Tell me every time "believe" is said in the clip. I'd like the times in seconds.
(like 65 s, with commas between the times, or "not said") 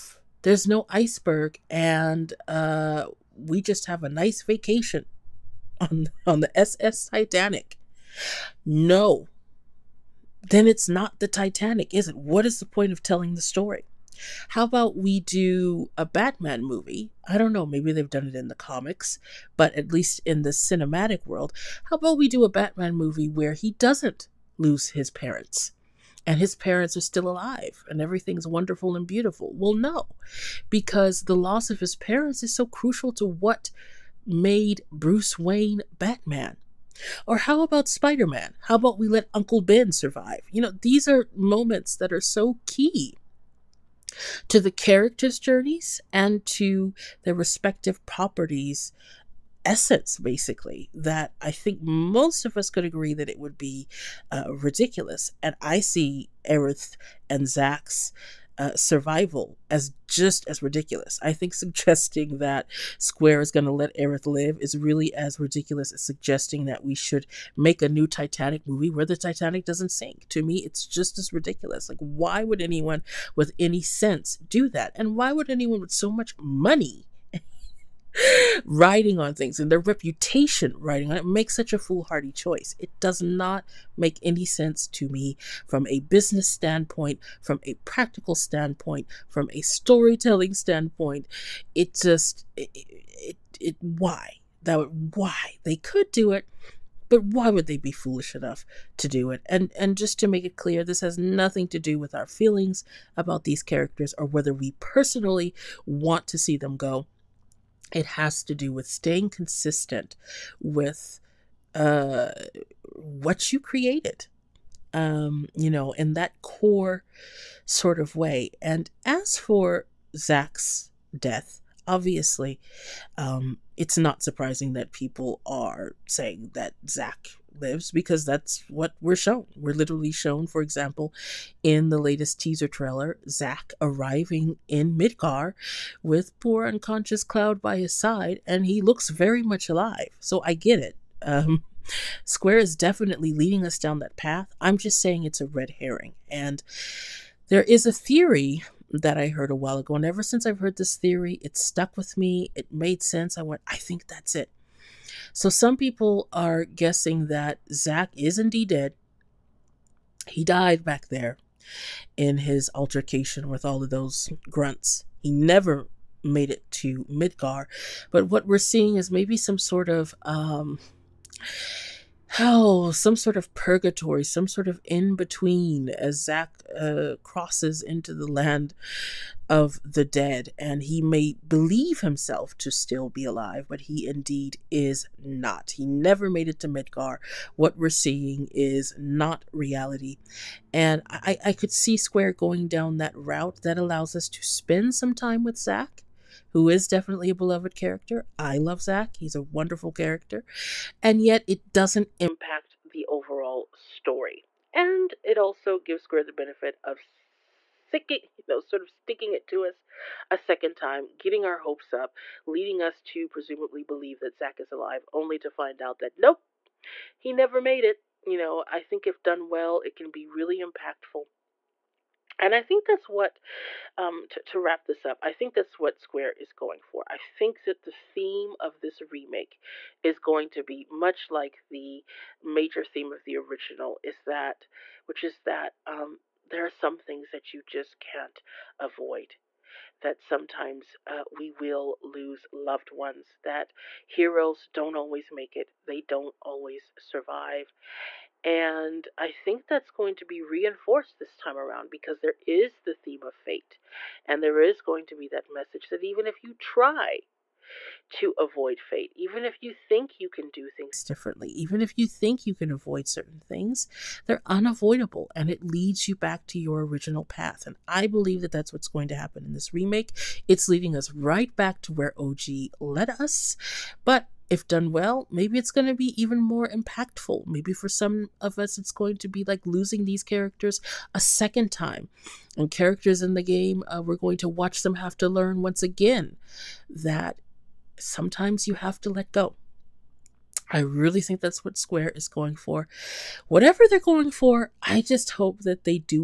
181 s, 213 s, 268 s.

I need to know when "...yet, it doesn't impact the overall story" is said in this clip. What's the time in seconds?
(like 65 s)
201 s.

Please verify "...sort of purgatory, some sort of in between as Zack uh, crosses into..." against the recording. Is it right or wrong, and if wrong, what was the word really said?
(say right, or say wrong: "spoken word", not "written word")
right.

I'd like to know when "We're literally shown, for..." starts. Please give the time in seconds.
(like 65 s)
129 s.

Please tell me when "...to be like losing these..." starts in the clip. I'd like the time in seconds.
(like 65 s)
279 s.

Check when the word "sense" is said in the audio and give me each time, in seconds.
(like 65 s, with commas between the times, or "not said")
73 s, 84 s, 153 s.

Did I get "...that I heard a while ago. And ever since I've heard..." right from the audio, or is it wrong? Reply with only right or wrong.
right.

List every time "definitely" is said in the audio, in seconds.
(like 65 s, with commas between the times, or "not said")
142 s, 196 s.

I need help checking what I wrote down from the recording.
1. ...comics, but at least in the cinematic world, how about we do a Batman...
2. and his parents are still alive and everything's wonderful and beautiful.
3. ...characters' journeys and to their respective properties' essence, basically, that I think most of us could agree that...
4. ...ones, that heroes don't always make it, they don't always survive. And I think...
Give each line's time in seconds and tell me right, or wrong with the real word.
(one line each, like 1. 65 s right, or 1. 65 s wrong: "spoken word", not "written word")
1. 18 s right
2. 26 s right
3. 44 s right
4. 242 s right.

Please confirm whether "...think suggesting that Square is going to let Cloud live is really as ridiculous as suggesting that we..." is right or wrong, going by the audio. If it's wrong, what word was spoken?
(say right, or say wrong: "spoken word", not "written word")
wrong: "Aerith", not "Cloud".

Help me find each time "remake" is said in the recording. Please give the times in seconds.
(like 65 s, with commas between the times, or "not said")
229 s, 269 s.